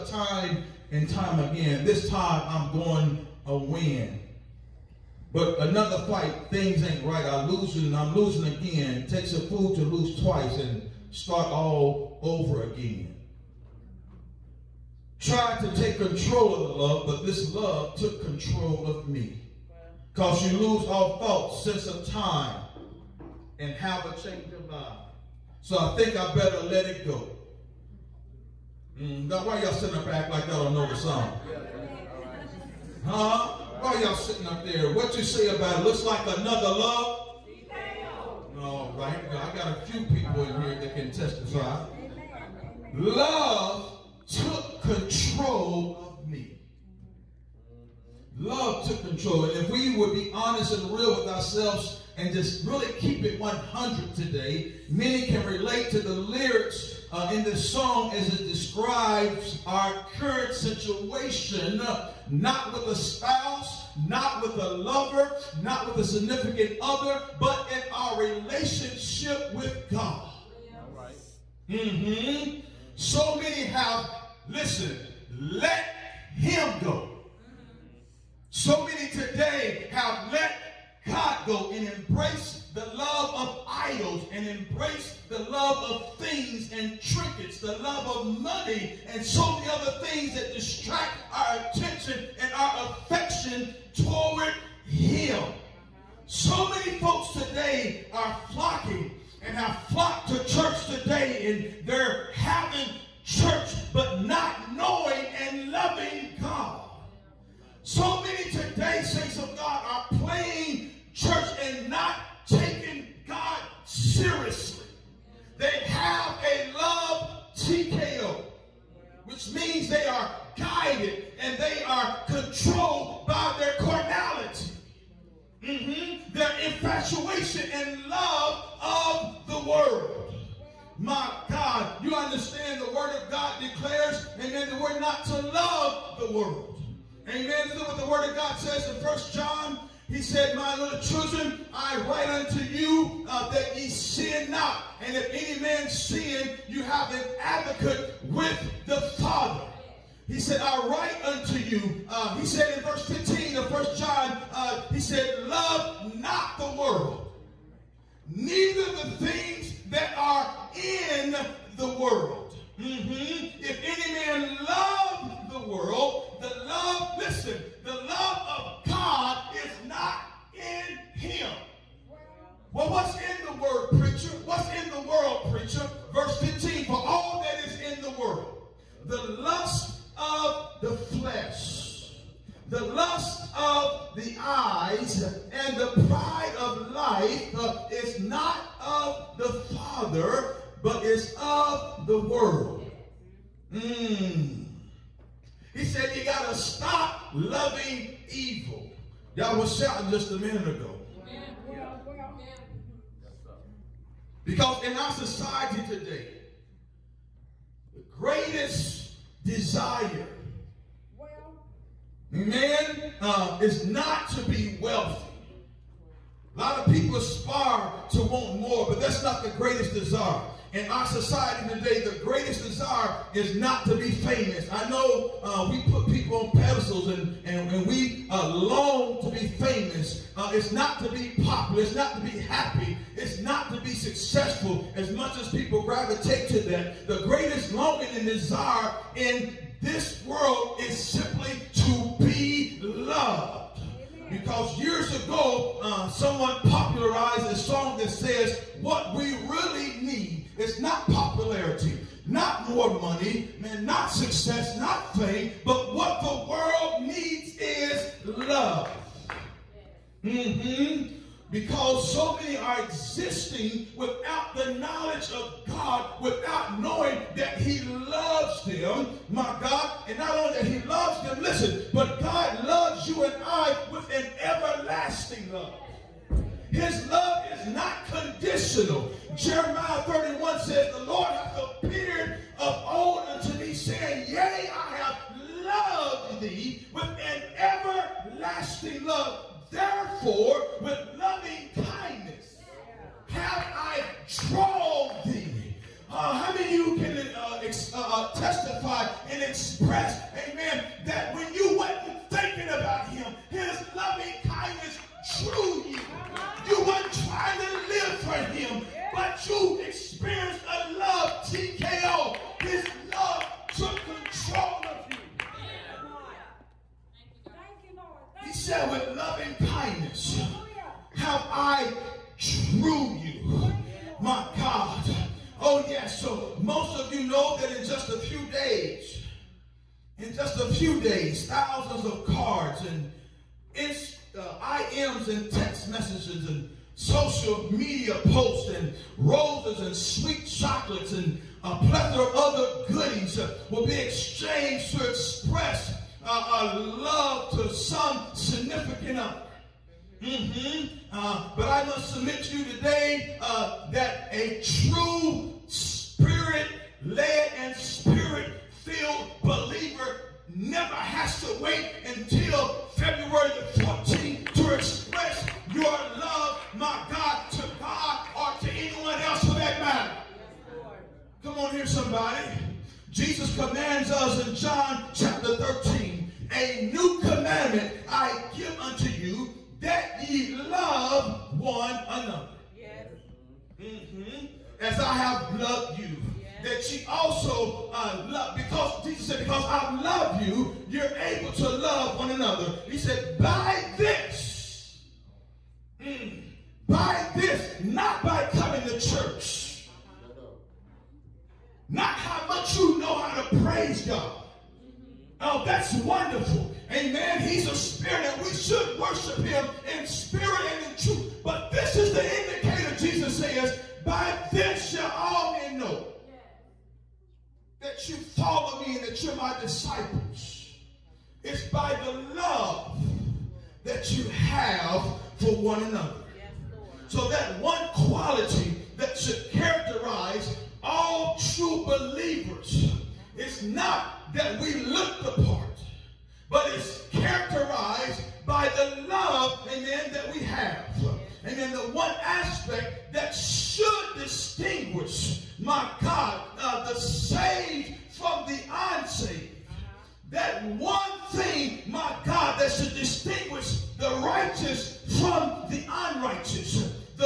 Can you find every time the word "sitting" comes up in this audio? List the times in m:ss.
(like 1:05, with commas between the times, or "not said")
0:29, 0:34.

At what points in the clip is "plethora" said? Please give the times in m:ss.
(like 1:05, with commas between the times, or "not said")
5:41.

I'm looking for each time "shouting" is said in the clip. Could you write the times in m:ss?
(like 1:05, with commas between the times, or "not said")
3:19.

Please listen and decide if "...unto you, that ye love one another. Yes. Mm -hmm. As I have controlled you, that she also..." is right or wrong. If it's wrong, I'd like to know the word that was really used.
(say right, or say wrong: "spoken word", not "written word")
wrong: "loved", not "controlled".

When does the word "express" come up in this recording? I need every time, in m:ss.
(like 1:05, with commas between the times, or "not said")
4:59, 5:45, 6:04.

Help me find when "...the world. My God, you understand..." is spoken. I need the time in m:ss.
2:09.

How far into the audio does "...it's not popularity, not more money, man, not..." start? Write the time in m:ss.
4:10.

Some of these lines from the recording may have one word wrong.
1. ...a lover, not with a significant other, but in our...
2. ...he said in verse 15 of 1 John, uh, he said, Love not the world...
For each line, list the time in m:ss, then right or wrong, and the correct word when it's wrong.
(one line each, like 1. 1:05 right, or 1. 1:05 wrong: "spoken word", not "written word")
1. 1:04 right
2. 2:32 right.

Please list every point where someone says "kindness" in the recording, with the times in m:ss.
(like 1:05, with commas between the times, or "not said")
4:51, 5:04, 5:19.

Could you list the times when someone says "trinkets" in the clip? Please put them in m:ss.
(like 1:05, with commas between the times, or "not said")
1:27.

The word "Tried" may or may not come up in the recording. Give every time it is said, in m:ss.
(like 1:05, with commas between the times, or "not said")
0:15.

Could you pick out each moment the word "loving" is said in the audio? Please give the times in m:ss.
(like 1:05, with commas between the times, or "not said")
1:45, 3:17, 4:51, 5:03, 5:19.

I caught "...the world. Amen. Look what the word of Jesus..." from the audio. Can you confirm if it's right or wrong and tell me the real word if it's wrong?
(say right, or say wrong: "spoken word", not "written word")
wrong: "God", not "Jesus".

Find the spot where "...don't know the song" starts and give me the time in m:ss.
0:30.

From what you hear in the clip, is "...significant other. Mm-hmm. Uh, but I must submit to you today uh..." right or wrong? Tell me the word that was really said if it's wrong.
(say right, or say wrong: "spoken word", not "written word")
right.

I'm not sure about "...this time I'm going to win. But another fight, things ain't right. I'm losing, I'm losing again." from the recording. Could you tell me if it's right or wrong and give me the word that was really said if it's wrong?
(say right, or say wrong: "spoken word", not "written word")
right.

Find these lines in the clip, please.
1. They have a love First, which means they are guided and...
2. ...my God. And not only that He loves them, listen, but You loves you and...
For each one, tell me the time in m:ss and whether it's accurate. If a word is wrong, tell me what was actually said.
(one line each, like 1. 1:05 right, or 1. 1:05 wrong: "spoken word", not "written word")
1. 1:55 wrong: "TKO", not "First"
2. 4:29 wrong: "God", not "You".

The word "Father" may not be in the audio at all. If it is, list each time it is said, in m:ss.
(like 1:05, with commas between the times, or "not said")
2:29, 3:09.